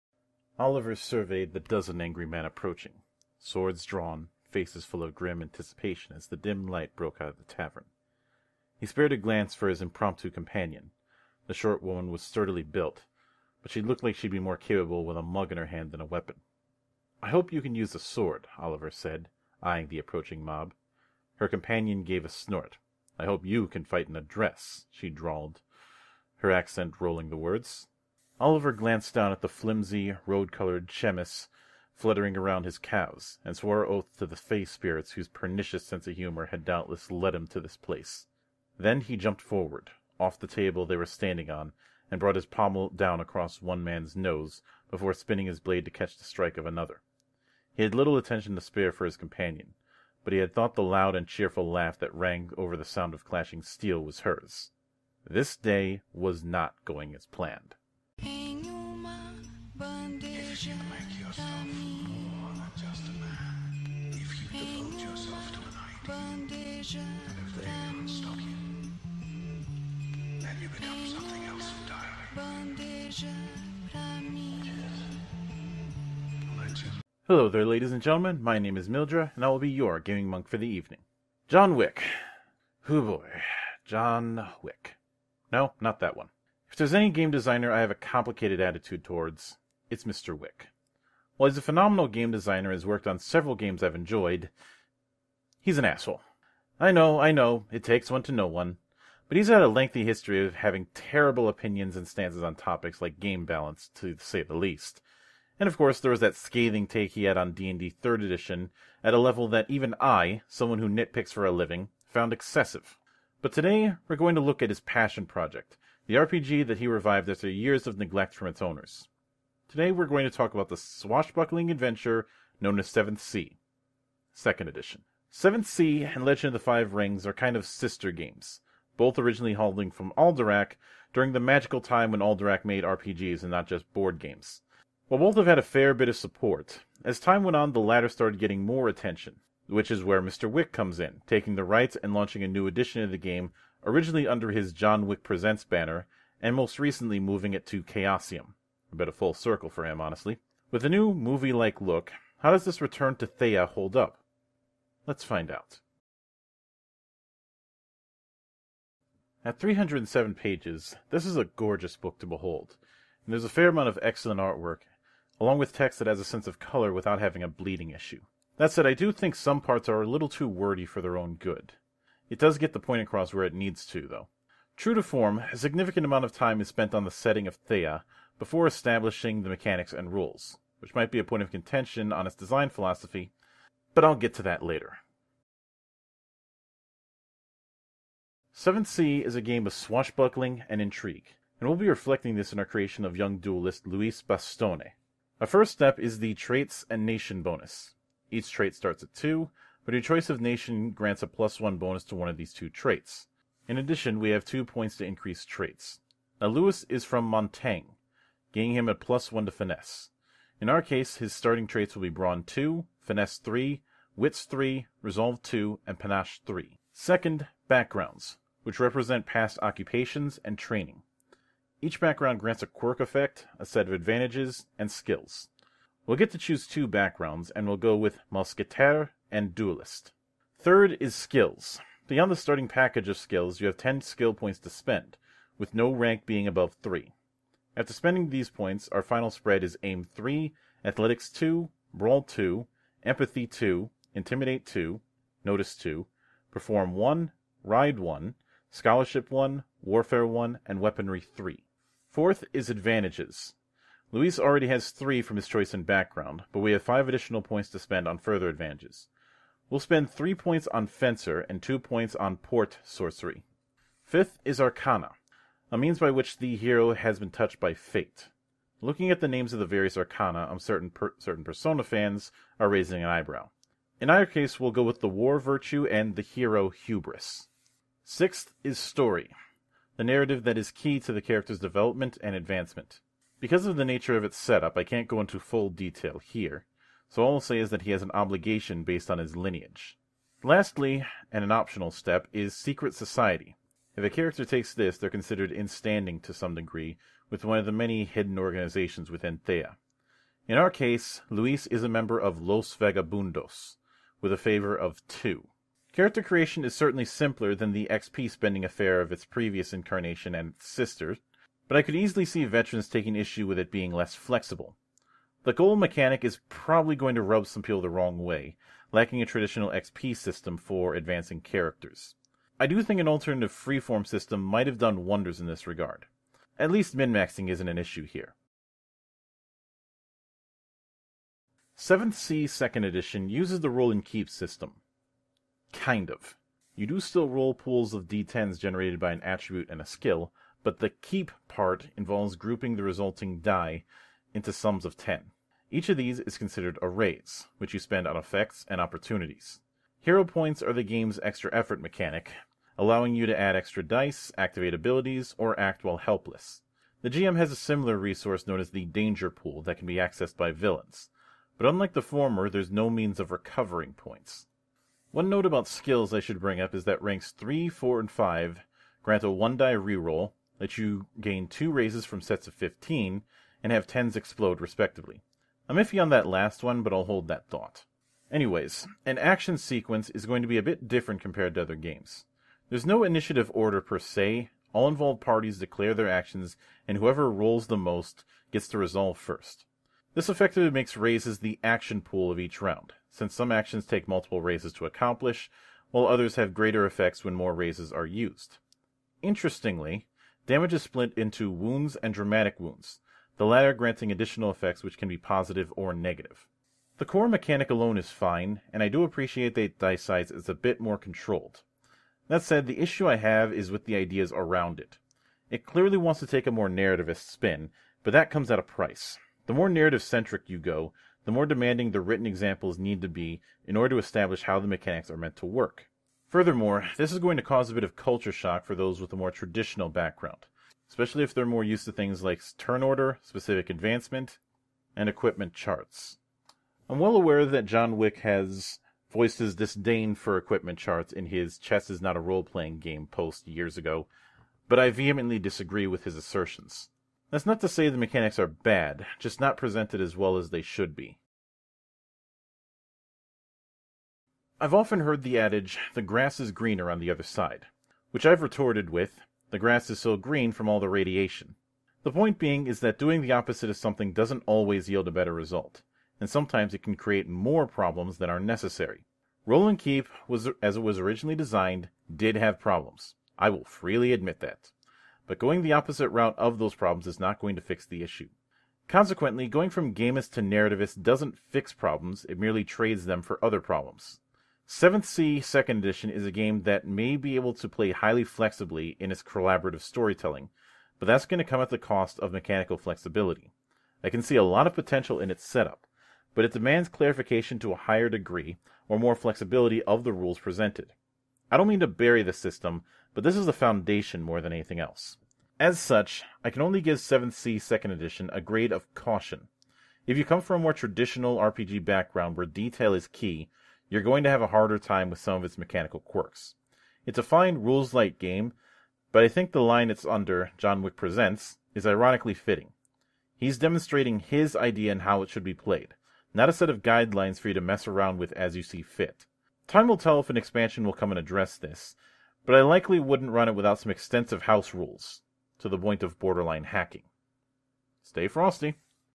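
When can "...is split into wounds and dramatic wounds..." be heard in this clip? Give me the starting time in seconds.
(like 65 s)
400 s.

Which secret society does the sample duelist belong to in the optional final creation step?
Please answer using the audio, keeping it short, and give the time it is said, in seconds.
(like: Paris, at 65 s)
Los Vagabundos, at 302 s.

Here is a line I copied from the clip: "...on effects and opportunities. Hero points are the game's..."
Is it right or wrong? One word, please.
right.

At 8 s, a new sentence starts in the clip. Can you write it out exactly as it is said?
He spared a glance for his impromptu companion.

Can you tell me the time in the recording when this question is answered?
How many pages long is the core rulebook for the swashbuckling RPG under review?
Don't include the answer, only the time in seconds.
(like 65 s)
159 s.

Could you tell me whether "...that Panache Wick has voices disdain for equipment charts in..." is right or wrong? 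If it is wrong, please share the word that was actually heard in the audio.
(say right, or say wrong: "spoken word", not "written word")
wrong: "John", not "Panache".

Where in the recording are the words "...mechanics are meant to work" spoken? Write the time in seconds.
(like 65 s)
424 s.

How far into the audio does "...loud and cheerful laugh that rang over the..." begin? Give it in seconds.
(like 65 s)
50 s.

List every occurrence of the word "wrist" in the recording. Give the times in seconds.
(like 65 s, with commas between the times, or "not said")
not said.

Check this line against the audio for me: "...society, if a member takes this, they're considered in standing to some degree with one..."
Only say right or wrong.
wrong.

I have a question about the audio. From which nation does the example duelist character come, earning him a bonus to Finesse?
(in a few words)
Montaigne.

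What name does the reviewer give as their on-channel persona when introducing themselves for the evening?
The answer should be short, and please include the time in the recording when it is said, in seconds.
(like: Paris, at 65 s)
Mildra, at 78 s.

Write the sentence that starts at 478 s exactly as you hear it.
Consequently, going from gamist to narrativist doesn't fix problems, it merely trades them for other problems.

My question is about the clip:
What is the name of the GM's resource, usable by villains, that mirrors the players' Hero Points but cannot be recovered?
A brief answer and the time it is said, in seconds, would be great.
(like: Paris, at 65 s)
Danger Pool, at 358 s.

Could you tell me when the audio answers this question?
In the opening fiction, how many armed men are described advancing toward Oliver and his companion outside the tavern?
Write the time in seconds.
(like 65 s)
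1 s.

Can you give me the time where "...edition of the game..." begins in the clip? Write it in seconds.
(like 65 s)
142 s.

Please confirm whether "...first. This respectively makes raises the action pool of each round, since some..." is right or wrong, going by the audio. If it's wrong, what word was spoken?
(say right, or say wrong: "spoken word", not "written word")
wrong: "effectively", not "respectively".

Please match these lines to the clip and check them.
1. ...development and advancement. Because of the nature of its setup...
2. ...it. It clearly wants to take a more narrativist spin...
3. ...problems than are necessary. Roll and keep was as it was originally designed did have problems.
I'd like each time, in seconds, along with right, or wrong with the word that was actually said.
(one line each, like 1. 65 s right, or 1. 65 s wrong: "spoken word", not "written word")
1. 281 s right
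2. 414 s right
3. 467 s right.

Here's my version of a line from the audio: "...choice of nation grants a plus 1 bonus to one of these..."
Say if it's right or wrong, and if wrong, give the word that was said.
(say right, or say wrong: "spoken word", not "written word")
right.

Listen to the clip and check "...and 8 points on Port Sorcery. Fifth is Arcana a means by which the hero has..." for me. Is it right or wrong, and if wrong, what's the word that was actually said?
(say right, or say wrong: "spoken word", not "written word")
wrong: "2", not "8".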